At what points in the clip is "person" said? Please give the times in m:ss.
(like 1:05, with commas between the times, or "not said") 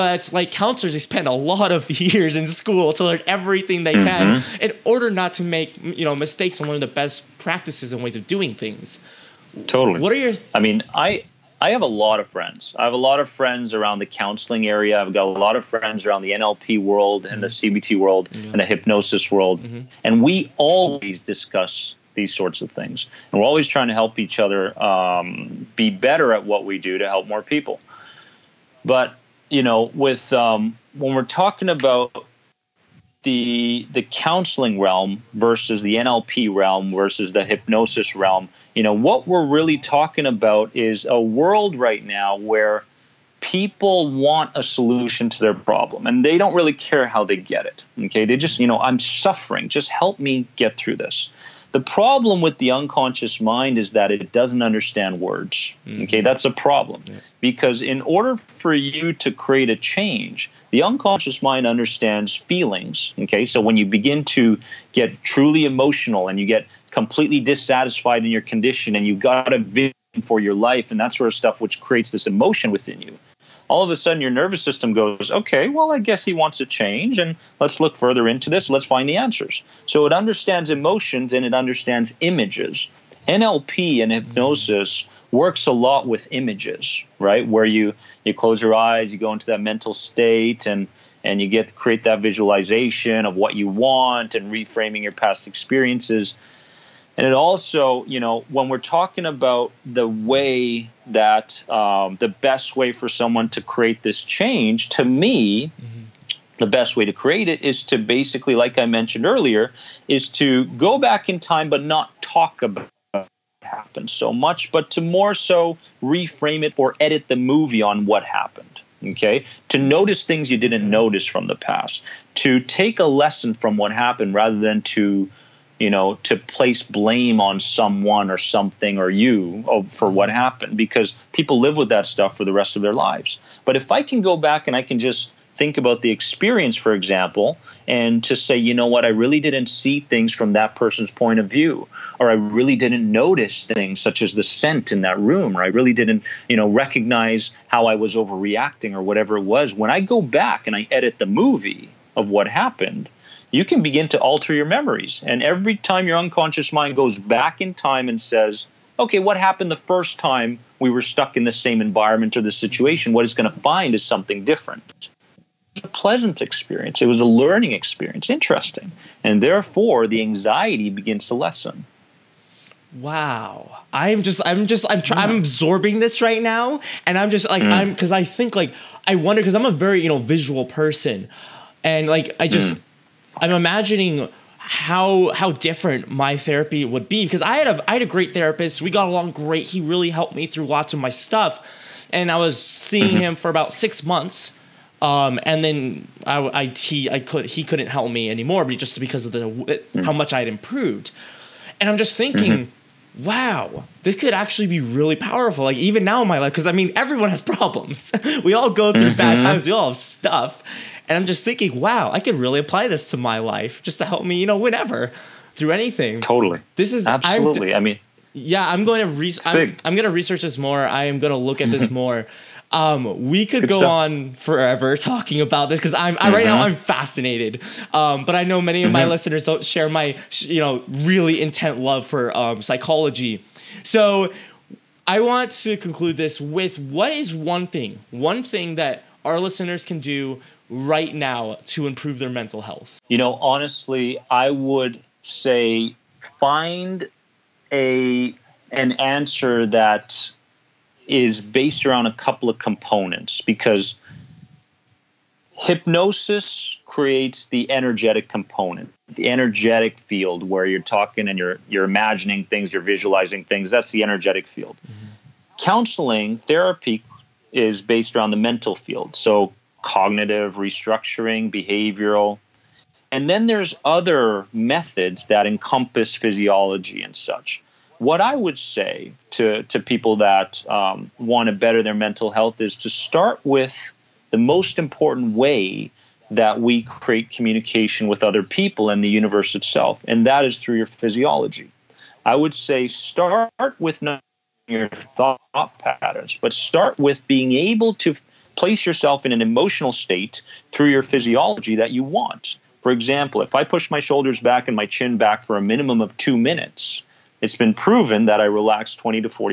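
2:20, 3:00.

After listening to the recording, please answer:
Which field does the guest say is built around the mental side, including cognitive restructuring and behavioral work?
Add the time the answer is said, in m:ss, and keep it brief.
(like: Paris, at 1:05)
Counseling therapy, at 4:25.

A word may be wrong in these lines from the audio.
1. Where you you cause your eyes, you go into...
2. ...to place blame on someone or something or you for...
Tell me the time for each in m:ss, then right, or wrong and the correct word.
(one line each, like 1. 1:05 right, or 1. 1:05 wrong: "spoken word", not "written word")
1. 1:27 wrong: "close", not "cause"
2. 2:06 right.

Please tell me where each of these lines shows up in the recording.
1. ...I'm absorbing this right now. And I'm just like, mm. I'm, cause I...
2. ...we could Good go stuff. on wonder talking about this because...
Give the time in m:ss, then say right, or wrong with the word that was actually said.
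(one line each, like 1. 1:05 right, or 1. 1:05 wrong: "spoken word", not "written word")
1. 2:55 right
2. 3:43 wrong: "forever", not "wonder".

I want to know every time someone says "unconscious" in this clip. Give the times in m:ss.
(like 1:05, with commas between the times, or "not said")
0:52, 1:00, 2:36.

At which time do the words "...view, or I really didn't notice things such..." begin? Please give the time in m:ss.
2:21.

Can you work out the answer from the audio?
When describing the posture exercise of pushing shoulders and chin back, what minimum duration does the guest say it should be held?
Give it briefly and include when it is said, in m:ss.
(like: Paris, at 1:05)
2 minutes, at 5:06.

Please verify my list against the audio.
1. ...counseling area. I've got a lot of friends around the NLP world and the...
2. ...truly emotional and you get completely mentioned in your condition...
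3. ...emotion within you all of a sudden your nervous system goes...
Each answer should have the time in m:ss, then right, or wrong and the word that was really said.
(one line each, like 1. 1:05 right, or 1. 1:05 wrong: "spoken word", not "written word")
1. 0:14 right
2. 1:05 wrong: "dissatisfied", not "mentioned"
3. 1:12 right.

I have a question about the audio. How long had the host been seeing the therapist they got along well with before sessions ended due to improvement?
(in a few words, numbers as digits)
About six months.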